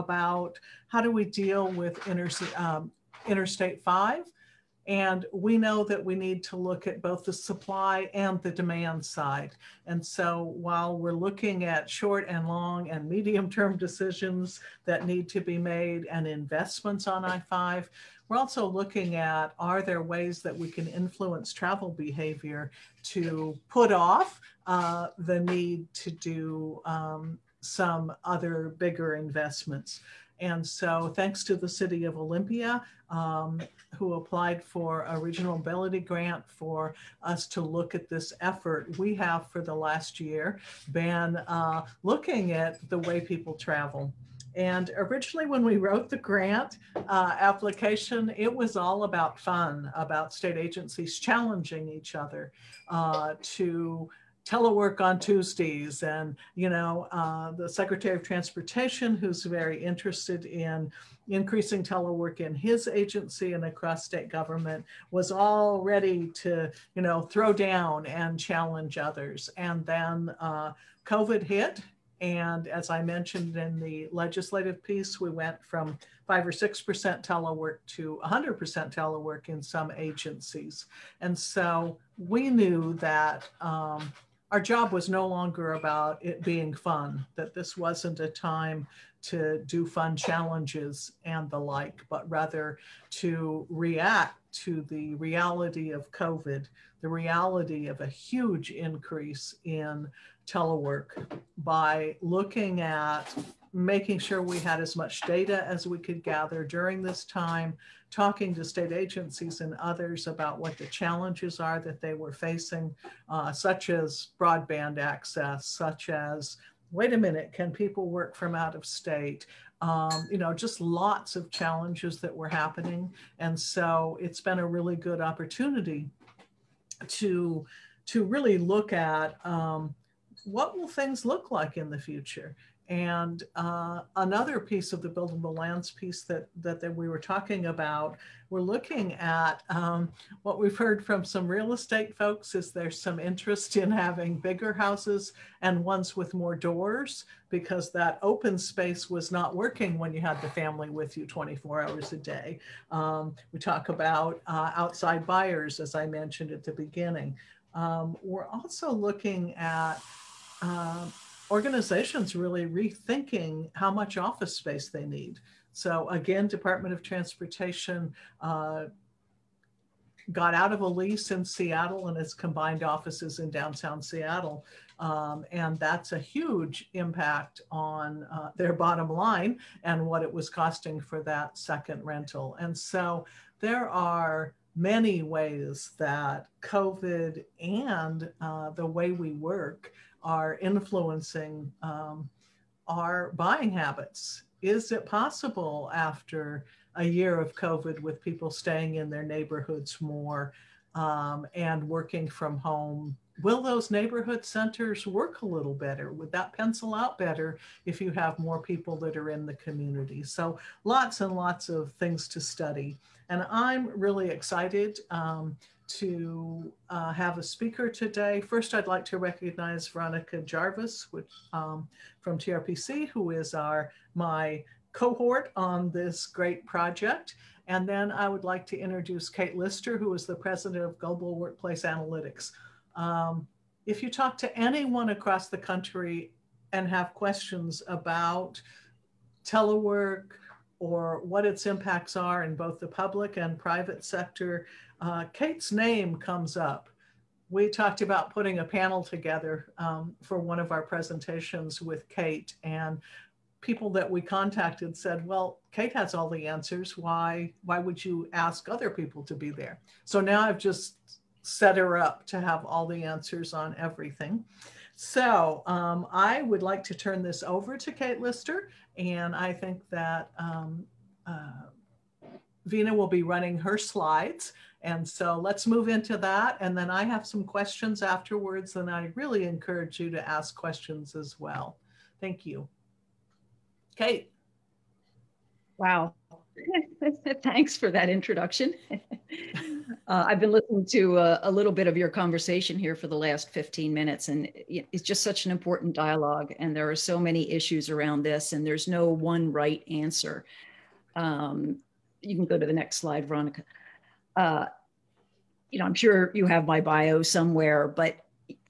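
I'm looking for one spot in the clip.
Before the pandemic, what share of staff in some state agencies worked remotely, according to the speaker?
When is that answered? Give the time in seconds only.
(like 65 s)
76 s.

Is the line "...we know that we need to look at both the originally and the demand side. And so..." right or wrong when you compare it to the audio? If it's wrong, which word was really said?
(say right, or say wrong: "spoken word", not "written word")
wrong: "supply", not "originally".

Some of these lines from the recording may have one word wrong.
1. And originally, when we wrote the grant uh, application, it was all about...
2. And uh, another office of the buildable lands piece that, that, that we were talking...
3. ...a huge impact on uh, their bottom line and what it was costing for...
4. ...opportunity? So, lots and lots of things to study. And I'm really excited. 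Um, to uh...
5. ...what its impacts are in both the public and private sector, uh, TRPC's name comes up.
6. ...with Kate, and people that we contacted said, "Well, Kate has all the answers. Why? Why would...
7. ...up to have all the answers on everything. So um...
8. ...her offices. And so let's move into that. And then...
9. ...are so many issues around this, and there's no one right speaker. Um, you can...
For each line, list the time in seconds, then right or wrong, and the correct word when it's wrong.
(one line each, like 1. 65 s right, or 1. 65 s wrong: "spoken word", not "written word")
1. 44 s right
2. 132 s wrong: "piece", not "office"
3. 176 s right
4. 209 s wrong: "community", not "opportunity"
5. 241 s wrong: "Kate", not "TRPC"
6. 251 s right
7. 261 s right
8. 273 s wrong: "slides", not "offices"
9. 296 s wrong: "answer", not "speaker".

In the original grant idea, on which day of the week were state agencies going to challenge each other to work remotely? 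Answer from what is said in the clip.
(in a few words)
Tuesdays.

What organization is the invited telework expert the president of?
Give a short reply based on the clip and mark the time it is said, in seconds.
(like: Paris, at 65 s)
Global Workplace Analytics, at 230 s.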